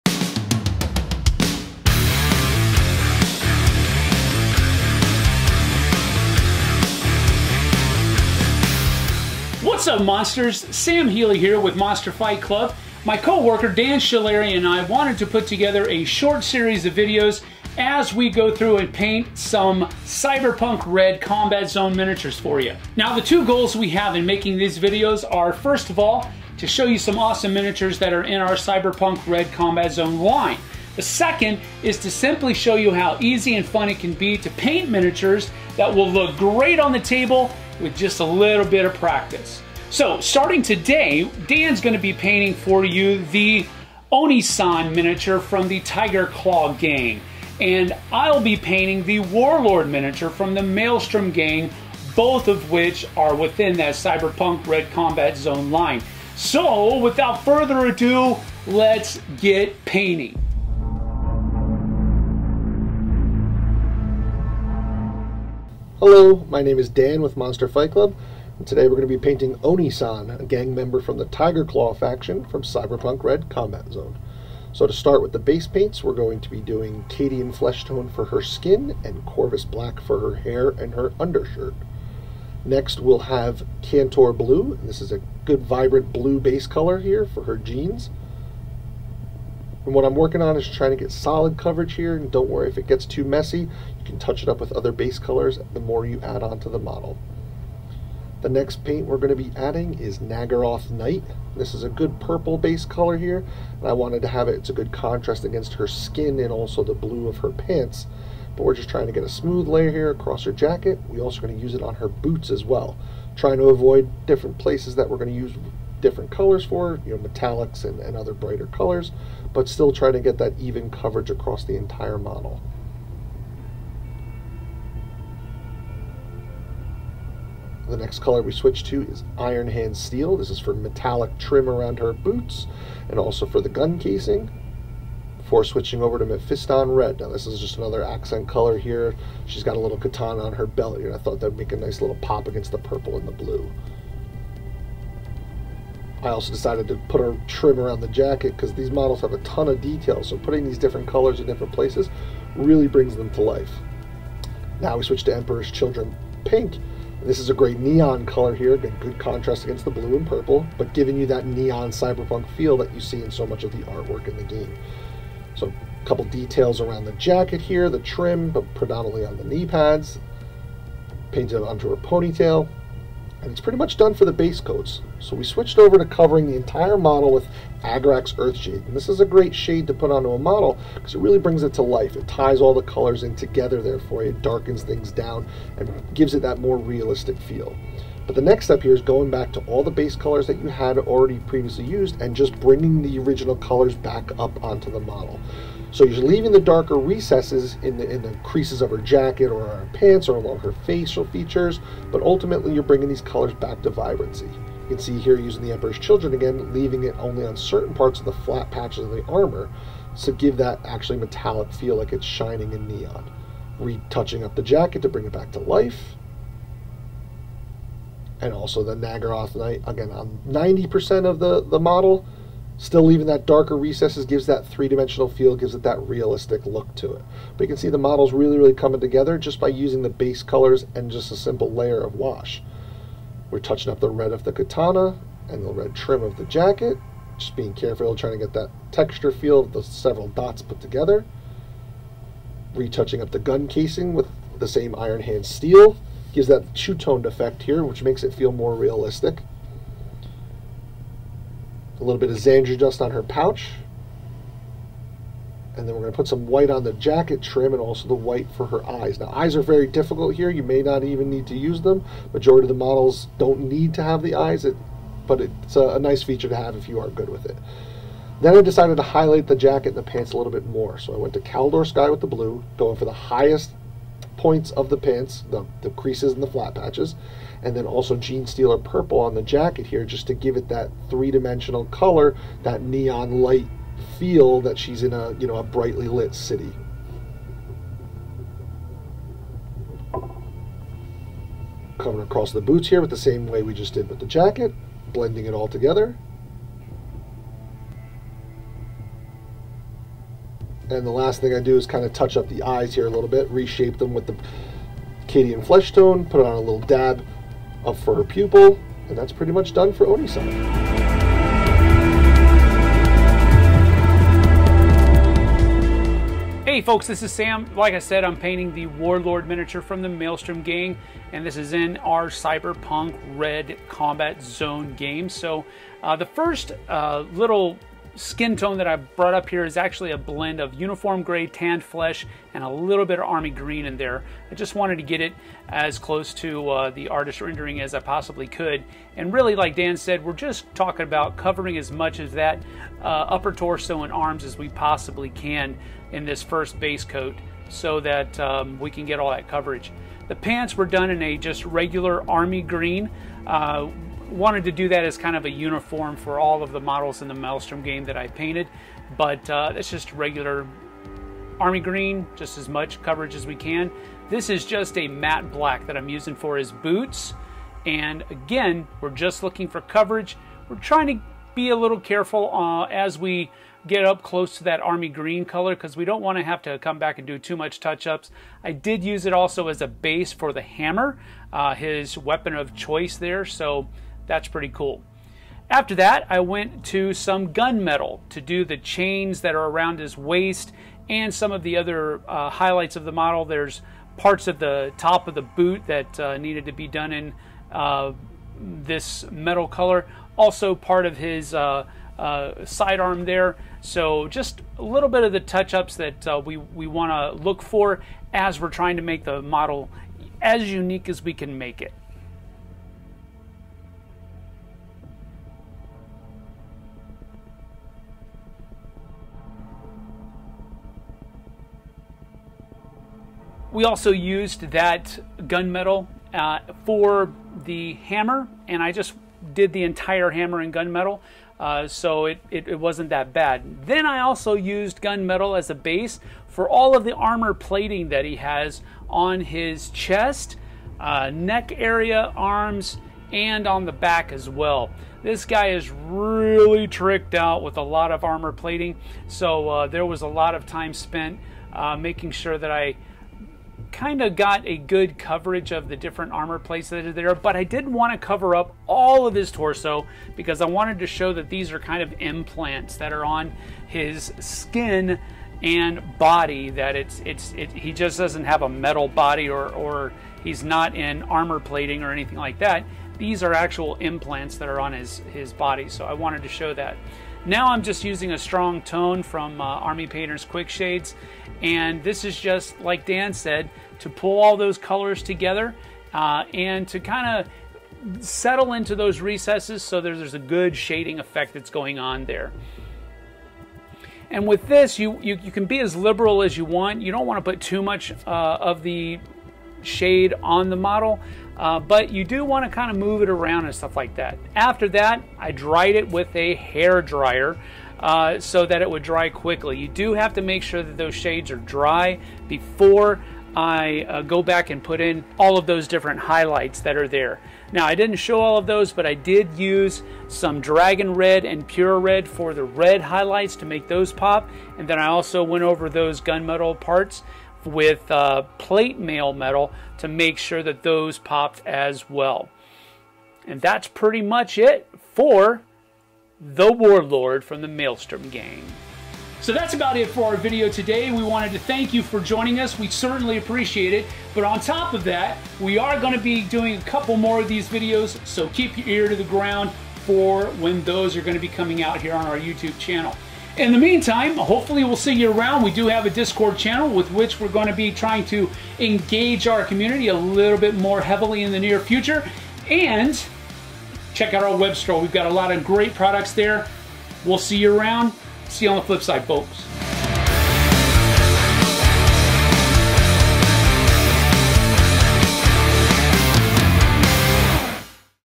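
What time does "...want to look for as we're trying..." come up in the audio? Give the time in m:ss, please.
6:46.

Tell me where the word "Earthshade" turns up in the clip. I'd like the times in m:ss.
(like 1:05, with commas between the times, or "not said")
2:58.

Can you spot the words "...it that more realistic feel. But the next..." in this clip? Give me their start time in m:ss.
3:06.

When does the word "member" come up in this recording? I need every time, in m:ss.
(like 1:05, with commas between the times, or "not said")
1:10.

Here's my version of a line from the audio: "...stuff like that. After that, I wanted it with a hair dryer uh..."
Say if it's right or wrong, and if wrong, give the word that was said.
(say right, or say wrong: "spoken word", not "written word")
wrong: "dried", not "wanted".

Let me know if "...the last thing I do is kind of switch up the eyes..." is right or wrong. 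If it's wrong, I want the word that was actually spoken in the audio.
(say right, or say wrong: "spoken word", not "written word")
wrong: "touch", not "switch".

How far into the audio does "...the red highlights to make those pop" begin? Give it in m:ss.
8:42.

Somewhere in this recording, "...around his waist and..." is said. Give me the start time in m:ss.
6:29.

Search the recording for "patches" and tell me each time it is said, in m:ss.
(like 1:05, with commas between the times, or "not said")
3:28, 4:36.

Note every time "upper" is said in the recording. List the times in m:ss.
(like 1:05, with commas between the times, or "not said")
5:43.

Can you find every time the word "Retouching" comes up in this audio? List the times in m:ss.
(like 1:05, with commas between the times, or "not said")
3:33, 4:02.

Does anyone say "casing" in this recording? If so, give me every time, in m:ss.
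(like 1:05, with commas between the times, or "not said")
2:13, 4:03.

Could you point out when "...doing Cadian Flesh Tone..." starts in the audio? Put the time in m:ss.
1:16.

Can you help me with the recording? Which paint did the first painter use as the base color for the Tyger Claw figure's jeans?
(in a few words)
Kantor Blue.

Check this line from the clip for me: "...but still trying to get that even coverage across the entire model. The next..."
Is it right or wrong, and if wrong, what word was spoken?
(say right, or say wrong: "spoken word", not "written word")
right.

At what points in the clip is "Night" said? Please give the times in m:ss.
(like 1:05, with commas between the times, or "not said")
1:40, 3:39.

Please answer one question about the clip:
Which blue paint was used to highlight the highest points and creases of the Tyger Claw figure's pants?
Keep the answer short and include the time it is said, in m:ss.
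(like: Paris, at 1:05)
Caledor Sky, at 4:31.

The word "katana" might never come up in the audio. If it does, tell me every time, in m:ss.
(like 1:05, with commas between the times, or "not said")
2:19, 3:54.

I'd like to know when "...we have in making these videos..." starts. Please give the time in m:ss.
0:23.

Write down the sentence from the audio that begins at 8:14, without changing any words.
And with this, you, you, you, can be as liberal as you want.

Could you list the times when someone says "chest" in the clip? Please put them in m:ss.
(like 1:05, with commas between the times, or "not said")
7:19.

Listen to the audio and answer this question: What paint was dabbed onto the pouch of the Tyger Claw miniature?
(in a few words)
Zandri Dust.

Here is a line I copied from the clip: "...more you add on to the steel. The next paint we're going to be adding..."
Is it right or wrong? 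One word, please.
wrong.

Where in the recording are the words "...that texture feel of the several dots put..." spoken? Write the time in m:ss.
3:58.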